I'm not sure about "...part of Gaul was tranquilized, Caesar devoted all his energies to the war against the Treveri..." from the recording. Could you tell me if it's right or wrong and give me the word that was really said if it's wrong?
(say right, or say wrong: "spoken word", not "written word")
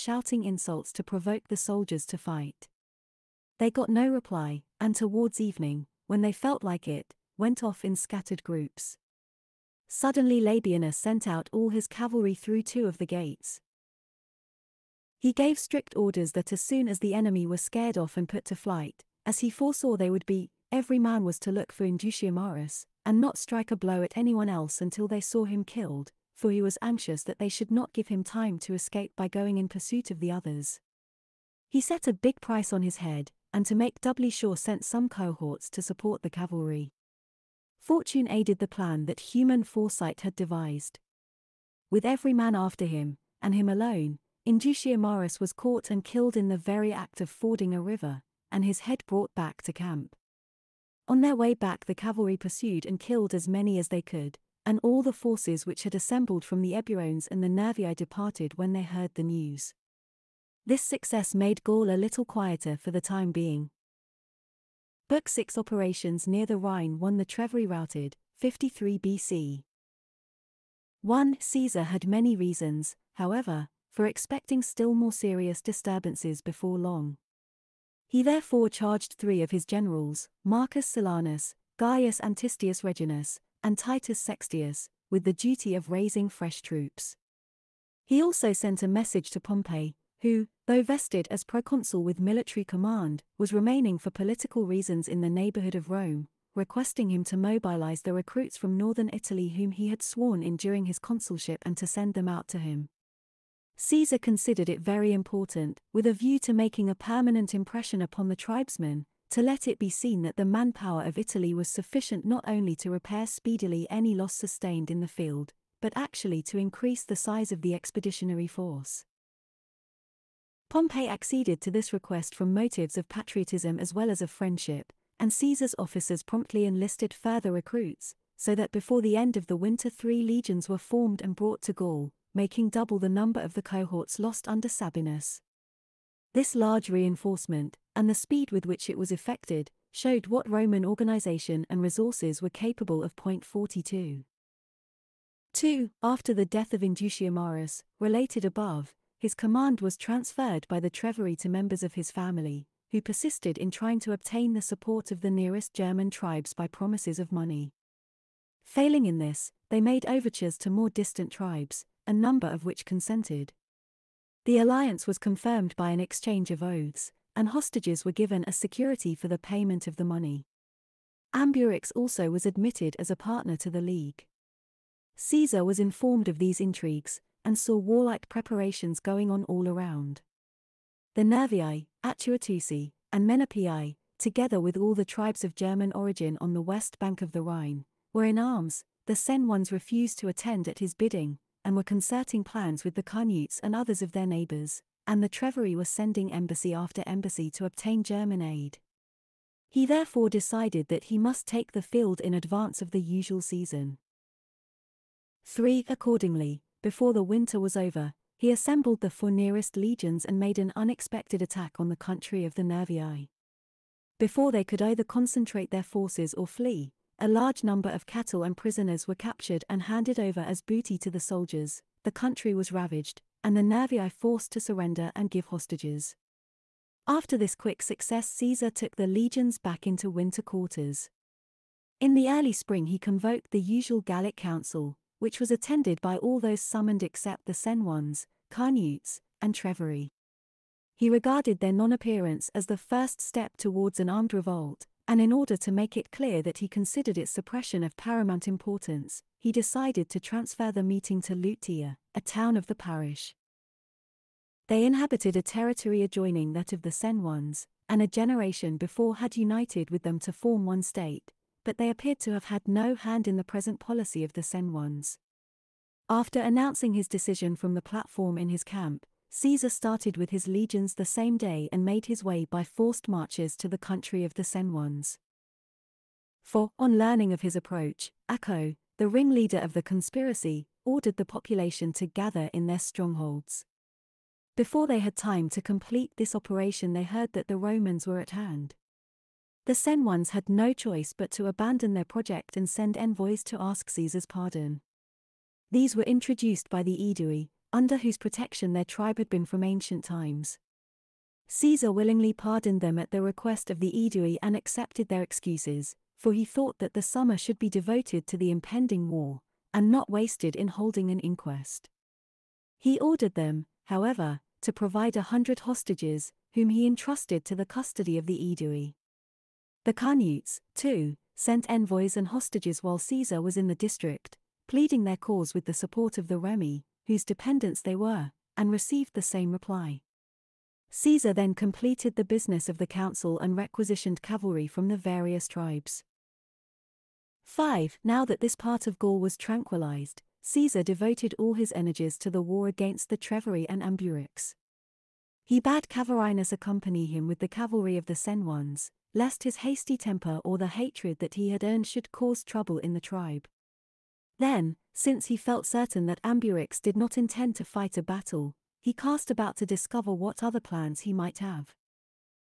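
right.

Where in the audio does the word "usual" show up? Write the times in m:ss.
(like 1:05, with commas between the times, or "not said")
3:23, 3:53.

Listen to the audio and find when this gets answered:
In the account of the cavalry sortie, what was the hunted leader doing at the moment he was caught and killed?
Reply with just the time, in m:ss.
0:47.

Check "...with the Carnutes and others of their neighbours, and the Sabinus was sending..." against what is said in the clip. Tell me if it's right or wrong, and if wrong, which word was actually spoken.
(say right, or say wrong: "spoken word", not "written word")
wrong: "Treveri", not "Sabinus".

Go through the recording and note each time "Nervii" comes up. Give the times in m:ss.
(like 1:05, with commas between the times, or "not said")
0:57, 3:01, 3:32, 3:43.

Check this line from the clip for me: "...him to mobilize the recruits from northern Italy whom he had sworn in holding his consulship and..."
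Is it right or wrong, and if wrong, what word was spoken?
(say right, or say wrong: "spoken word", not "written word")
wrong: "during", not "holding".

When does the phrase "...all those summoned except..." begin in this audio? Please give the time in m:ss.
3:56.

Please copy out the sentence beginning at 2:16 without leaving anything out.
This large reinforcement, and the speed with which it was effected, showed what Roman organization and resources were capable of.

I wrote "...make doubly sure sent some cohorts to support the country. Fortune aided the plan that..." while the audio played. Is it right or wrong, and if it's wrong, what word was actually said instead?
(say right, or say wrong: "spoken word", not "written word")
wrong: "cavalry", not "country".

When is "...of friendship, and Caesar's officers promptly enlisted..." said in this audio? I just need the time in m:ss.
2:04.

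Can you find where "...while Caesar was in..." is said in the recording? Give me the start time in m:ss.
5:22.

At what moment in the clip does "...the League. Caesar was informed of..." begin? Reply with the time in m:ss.
2:53.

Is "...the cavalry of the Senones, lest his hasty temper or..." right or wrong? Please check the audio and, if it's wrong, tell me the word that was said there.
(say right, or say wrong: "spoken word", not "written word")
right.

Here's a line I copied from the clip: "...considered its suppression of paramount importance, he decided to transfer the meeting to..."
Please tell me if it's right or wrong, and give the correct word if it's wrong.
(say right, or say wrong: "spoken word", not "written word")
right.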